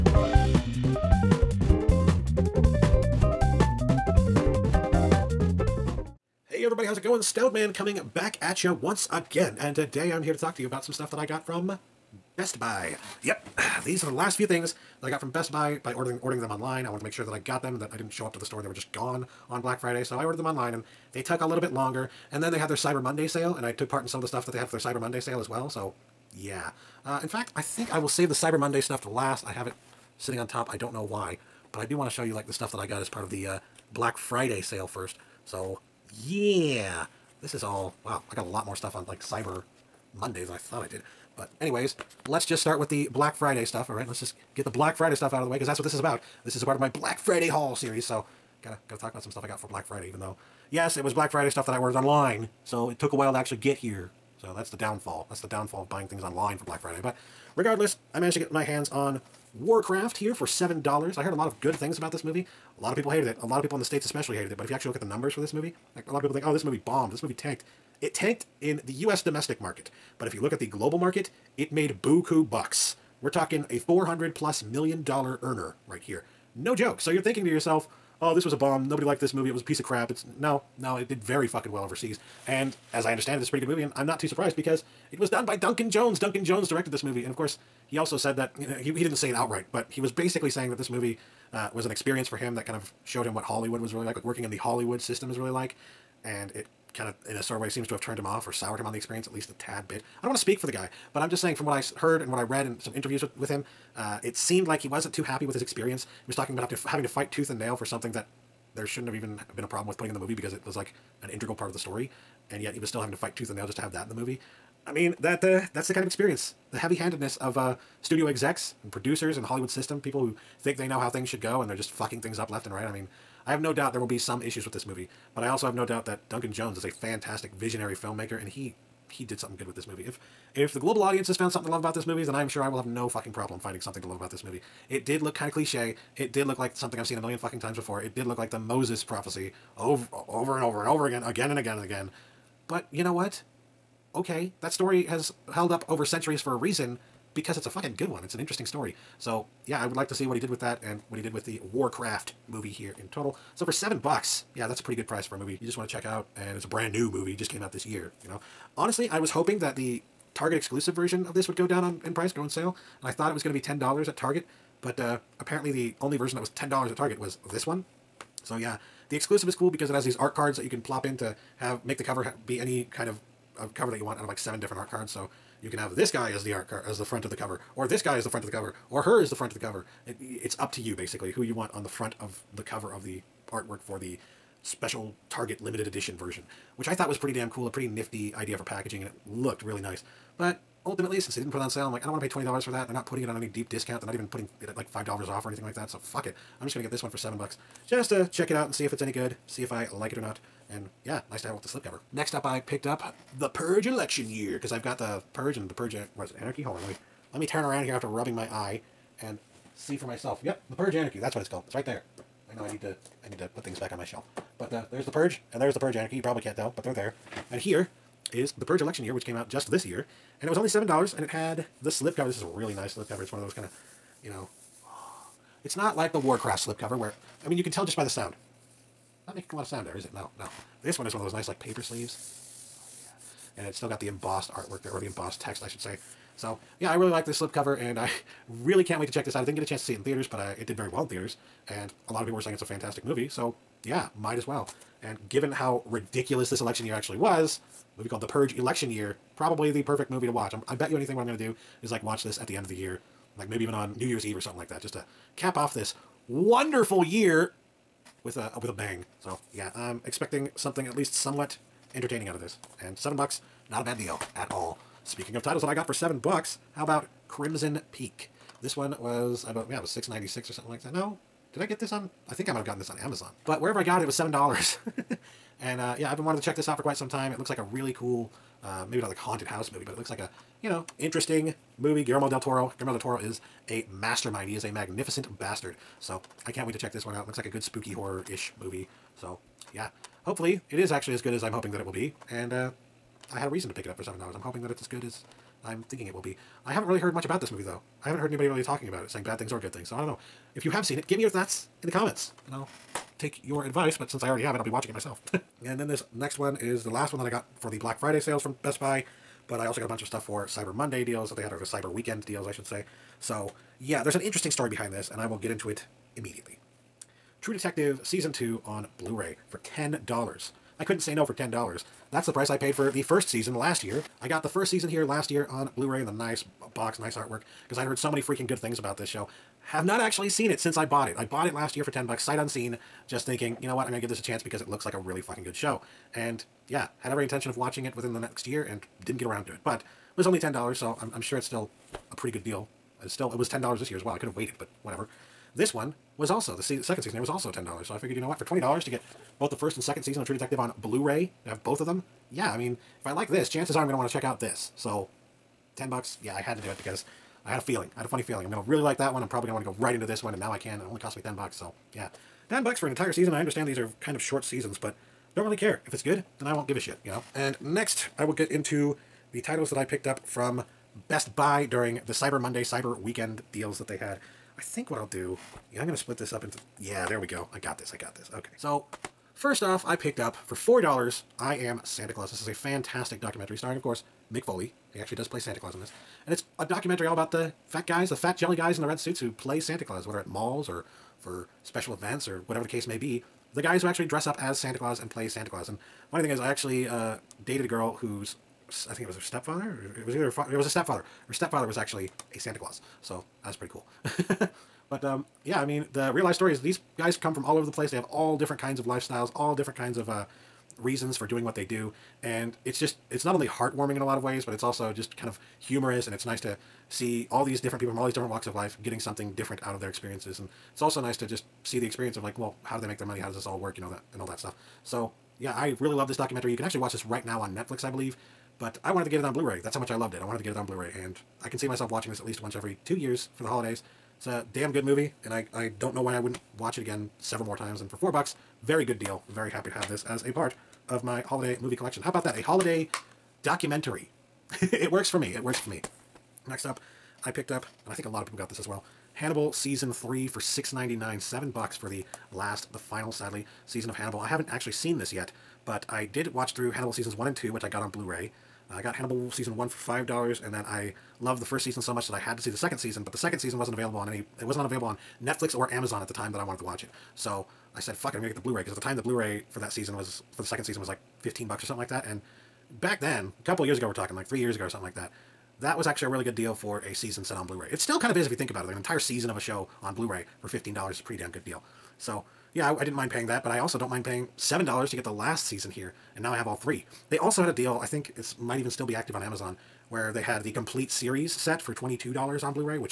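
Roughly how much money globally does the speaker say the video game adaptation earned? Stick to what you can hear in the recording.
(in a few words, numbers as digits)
400 million dollars.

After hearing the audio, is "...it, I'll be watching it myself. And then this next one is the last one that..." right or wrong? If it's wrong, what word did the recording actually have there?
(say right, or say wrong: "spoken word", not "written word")
right.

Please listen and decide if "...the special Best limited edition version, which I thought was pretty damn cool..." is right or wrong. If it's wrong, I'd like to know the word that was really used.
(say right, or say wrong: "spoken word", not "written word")
wrong: "Target", not "Best".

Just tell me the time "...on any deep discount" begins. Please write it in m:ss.
3:13.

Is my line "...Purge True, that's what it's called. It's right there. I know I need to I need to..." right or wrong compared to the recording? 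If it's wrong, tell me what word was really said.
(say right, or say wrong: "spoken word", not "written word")
wrong: "Anarchy", not "True".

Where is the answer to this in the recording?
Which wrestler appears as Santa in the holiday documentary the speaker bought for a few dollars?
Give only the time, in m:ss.
6:24.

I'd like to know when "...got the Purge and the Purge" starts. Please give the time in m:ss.
3:24.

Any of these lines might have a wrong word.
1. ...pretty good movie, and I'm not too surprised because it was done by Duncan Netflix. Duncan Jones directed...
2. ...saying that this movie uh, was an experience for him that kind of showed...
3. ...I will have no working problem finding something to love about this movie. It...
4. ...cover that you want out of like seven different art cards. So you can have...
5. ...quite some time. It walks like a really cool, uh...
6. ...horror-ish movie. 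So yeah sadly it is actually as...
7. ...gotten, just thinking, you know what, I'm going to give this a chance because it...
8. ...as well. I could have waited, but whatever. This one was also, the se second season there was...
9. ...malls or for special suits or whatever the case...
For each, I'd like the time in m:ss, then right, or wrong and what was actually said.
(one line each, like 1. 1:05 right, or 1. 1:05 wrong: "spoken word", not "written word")
1. 1:23 wrong: "Jones", not "Netflix"
2. 1:30 right
3. 2:12 wrong: "fucking", not "working"
4. 2:53 right
5. 4:36 wrong: "looks", not "walks"
6. 4:47 wrong: "hopefully", not "sadly"
7. 5:32 wrong: "unseen", not "gotten"
8. 5:43 right
9. 6:30 wrong: "events", not "suits".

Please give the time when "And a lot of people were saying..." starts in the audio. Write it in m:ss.
4:01.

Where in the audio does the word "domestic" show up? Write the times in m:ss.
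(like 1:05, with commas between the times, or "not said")
1:09.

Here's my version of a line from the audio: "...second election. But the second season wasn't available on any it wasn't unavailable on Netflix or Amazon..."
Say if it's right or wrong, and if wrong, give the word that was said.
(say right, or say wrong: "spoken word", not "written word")
wrong: "season", not "election".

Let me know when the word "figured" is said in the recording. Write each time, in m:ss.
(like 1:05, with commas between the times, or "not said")
5:47.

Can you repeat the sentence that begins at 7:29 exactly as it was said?
Hannibal season three for six ninety nine, seven bucks for the last, the final, sadly, season of Hannibal.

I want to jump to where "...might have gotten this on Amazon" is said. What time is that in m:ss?
4:32.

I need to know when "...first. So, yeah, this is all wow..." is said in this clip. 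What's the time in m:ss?
0:34.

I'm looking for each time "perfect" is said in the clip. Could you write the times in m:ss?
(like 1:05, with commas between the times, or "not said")
4:09.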